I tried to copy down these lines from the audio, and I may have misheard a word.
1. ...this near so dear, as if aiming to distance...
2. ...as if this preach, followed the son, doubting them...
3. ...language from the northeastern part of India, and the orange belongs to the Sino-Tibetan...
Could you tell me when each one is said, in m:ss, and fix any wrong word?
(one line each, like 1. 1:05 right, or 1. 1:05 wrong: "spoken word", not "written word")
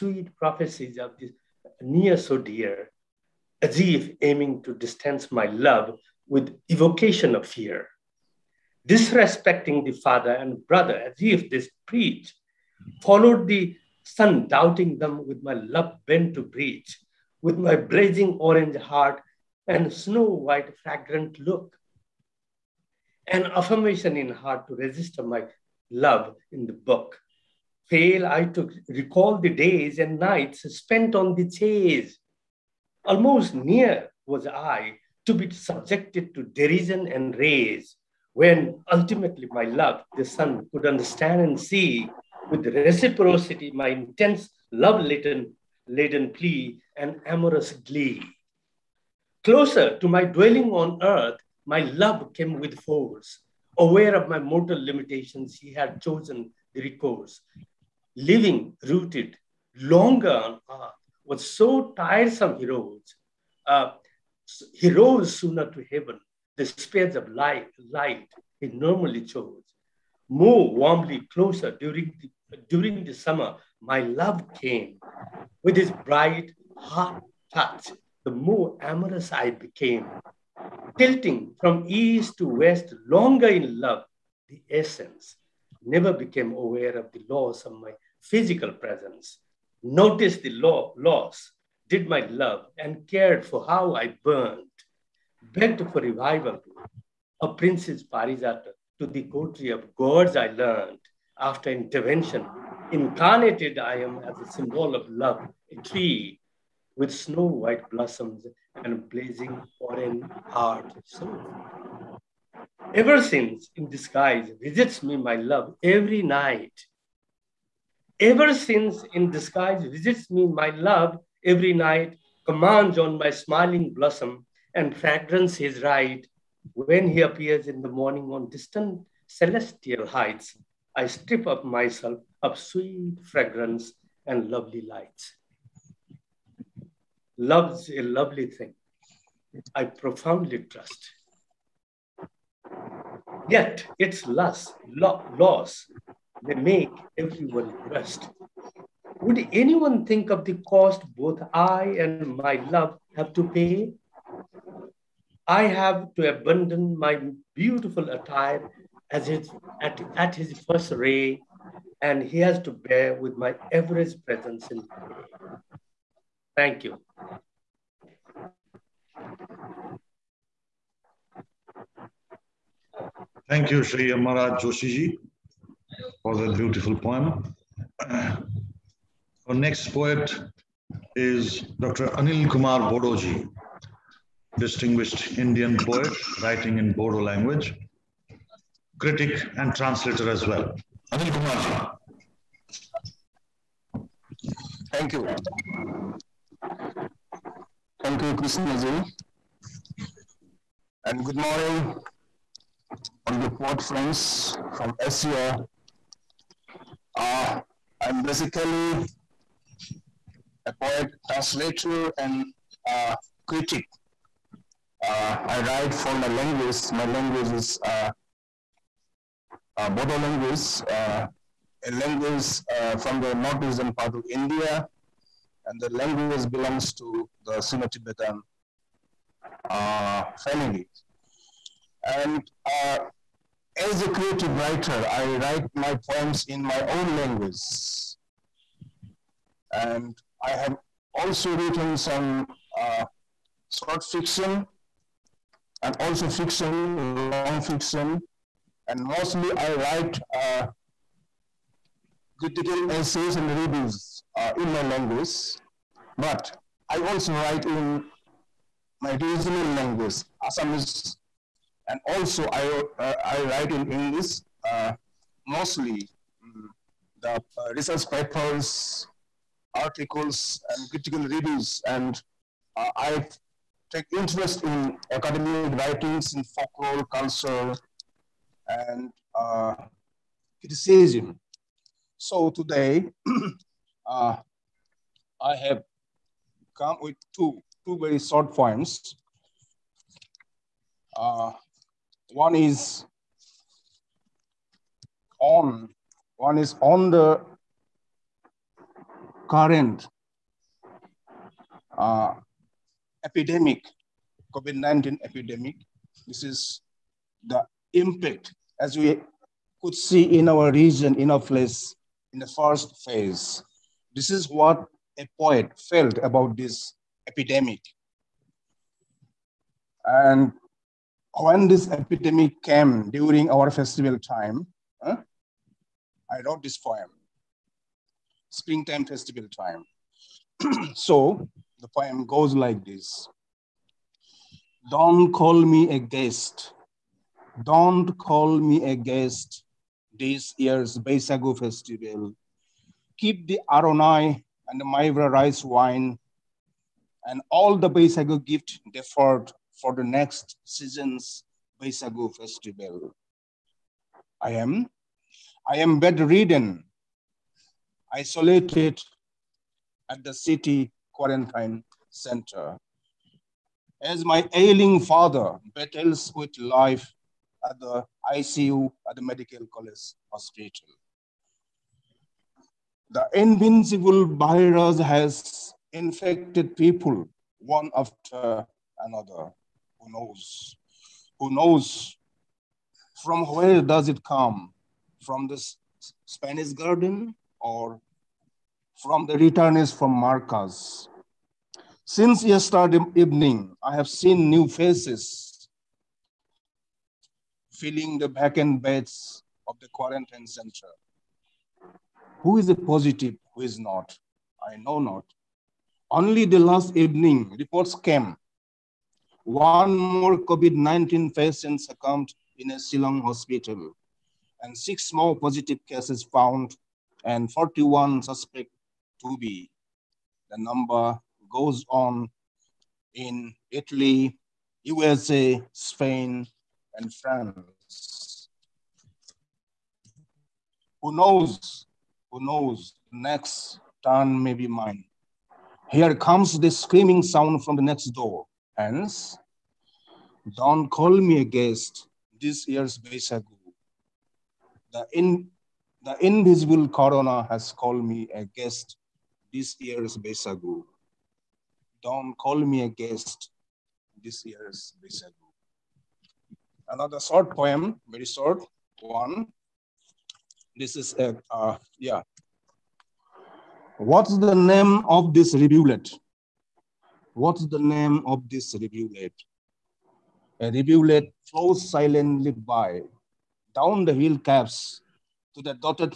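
1. 0:01 right
2. 0:10 right
3. 3:41 wrong: "language", not "orange".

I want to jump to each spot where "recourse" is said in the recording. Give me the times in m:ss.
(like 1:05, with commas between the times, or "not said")
0:56.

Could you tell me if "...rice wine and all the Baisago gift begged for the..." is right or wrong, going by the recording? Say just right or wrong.
wrong.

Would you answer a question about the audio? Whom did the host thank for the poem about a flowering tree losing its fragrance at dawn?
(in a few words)
Sri Amar Raj Joshiji.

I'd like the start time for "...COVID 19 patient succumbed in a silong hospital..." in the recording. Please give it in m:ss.
6:50.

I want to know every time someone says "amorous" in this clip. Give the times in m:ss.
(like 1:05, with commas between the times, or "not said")
0:47, 1:18.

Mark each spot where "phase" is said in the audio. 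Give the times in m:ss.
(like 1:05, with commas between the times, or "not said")
5:13.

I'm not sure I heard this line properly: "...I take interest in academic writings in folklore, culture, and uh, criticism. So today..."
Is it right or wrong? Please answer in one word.
right.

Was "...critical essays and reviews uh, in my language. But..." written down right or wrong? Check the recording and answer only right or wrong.
right.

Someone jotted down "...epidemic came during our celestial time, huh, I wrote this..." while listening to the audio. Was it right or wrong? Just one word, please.
wrong.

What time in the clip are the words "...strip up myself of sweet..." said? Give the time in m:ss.
2:11.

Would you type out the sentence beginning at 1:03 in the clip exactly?
Uh, he rose sooner to heaven the speeds of light, light he normally chose, move warmly closer during the, during the summer.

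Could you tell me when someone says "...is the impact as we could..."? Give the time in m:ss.
5:06.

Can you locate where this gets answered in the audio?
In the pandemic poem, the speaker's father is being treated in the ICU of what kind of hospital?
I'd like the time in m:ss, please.
6:09.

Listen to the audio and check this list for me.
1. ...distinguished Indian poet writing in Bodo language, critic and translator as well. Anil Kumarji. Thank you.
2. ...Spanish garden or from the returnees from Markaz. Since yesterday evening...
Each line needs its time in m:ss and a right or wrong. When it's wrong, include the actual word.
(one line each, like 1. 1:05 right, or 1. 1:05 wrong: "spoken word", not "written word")
1. 3:04 right
2. 6:26 right.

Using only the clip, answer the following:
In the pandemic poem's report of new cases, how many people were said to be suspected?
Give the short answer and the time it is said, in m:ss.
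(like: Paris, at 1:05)
41, at 6:57.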